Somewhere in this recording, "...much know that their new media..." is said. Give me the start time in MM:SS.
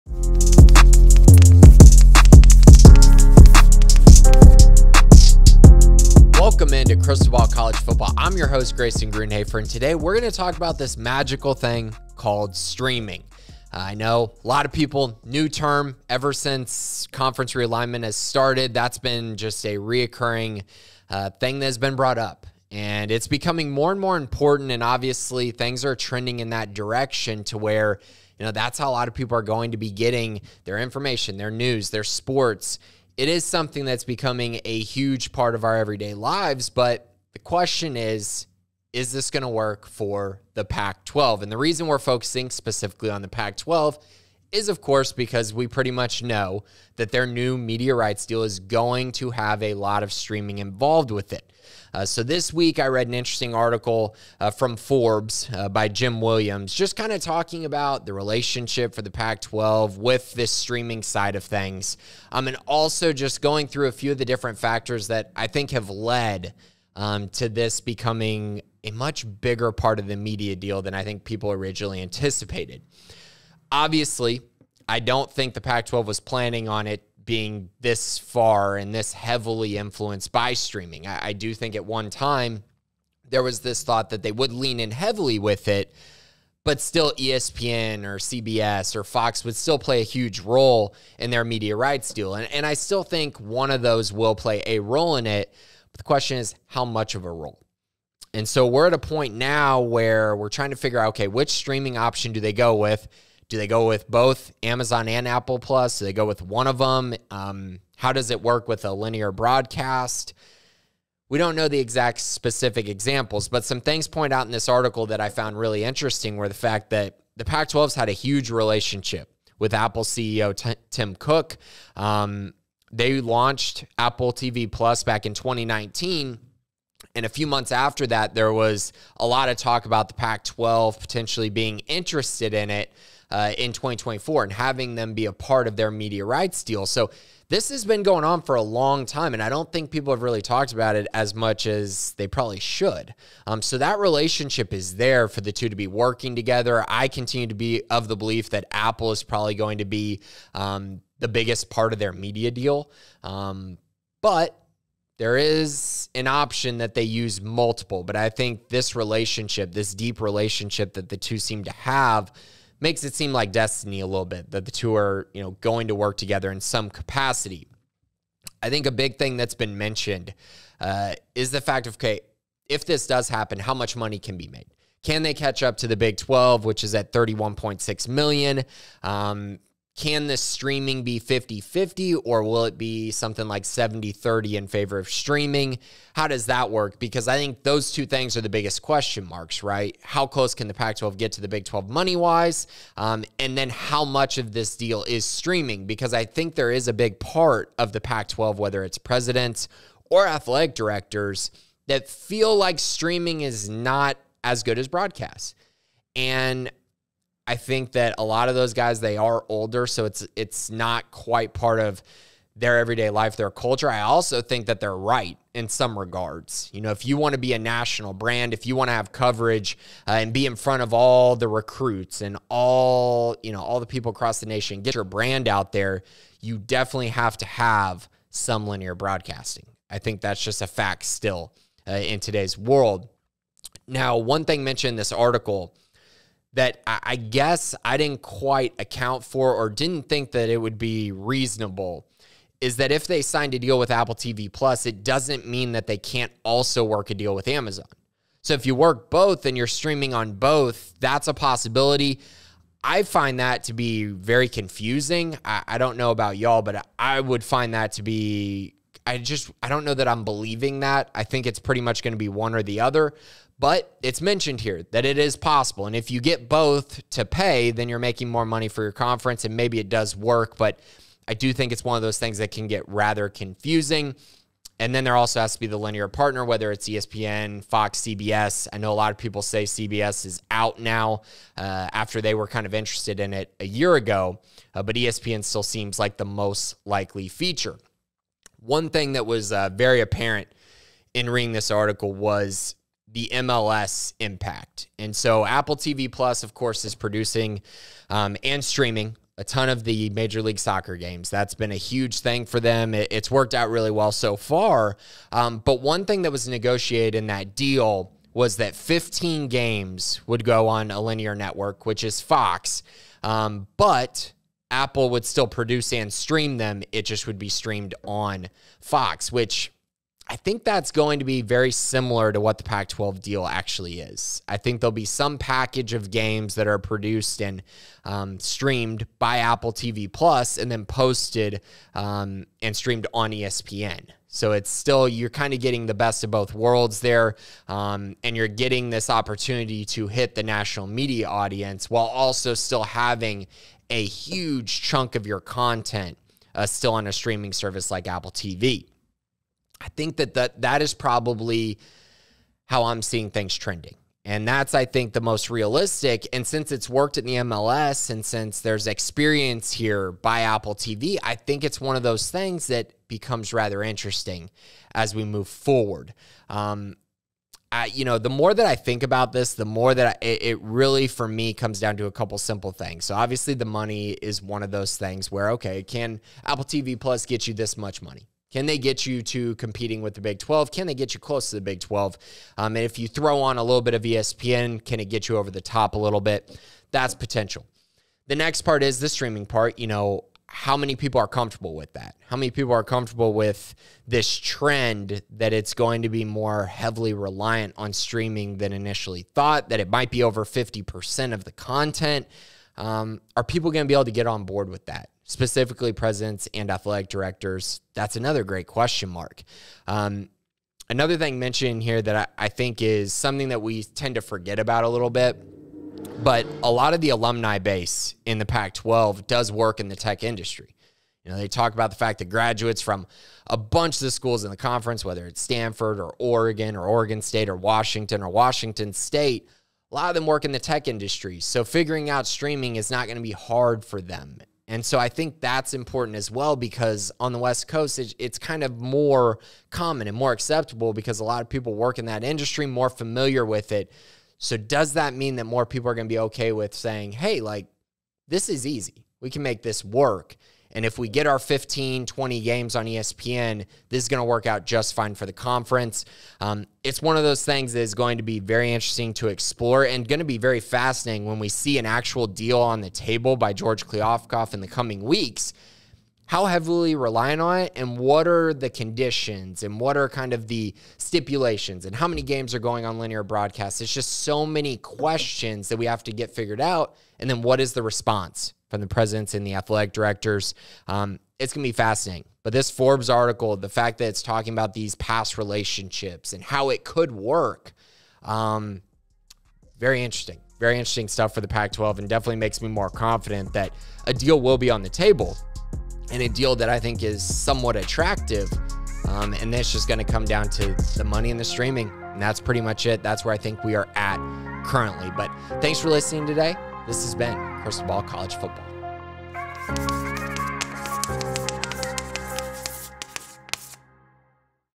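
00:45.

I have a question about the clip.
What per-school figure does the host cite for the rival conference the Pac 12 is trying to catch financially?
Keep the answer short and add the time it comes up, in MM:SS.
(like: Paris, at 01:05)
31.6 million, at 02:57.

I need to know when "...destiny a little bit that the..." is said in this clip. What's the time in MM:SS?
02:43.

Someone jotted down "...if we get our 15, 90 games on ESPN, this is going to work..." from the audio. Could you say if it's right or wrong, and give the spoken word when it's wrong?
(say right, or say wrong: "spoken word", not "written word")
wrong: "20", not "90".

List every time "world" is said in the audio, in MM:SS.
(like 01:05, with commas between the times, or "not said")
03:52, 05:36.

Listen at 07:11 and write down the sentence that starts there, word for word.
So figuring out streaming is not going to be hard for them.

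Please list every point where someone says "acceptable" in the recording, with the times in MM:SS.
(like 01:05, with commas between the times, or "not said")
07:20.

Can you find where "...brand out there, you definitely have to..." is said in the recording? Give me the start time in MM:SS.
03:45.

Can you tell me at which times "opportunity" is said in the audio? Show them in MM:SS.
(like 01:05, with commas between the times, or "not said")
05:39.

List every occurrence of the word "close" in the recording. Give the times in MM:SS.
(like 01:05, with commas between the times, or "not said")
03:10, 06:21.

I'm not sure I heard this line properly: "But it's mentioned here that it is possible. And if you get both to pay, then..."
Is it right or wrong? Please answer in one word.
right.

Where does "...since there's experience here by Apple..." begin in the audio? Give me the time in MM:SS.
05:58.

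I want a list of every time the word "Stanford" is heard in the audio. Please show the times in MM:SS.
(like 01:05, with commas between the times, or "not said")
07:05.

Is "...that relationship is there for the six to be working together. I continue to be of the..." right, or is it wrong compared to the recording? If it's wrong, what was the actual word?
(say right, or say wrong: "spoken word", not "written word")
wrong: "two", not "six".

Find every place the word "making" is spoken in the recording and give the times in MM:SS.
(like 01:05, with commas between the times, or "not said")
04:27.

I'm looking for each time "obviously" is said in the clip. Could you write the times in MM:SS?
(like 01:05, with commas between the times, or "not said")
00:24, 01:13, 06:13.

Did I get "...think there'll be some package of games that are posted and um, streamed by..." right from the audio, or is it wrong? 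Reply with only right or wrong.
wrong.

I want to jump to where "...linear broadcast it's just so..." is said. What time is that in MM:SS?
07:52.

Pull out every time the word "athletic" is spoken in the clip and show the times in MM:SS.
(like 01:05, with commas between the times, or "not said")
03:20, 06:46, 07:59.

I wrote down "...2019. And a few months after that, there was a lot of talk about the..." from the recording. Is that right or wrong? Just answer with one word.
right.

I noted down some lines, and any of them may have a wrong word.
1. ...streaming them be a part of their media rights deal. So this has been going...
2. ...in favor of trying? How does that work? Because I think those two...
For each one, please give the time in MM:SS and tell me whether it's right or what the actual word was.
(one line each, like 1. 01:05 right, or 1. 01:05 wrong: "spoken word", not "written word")
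1. 02:14 wrong: "having", not "streaming"
2. 03:04 wrong: "streaming", not "trying".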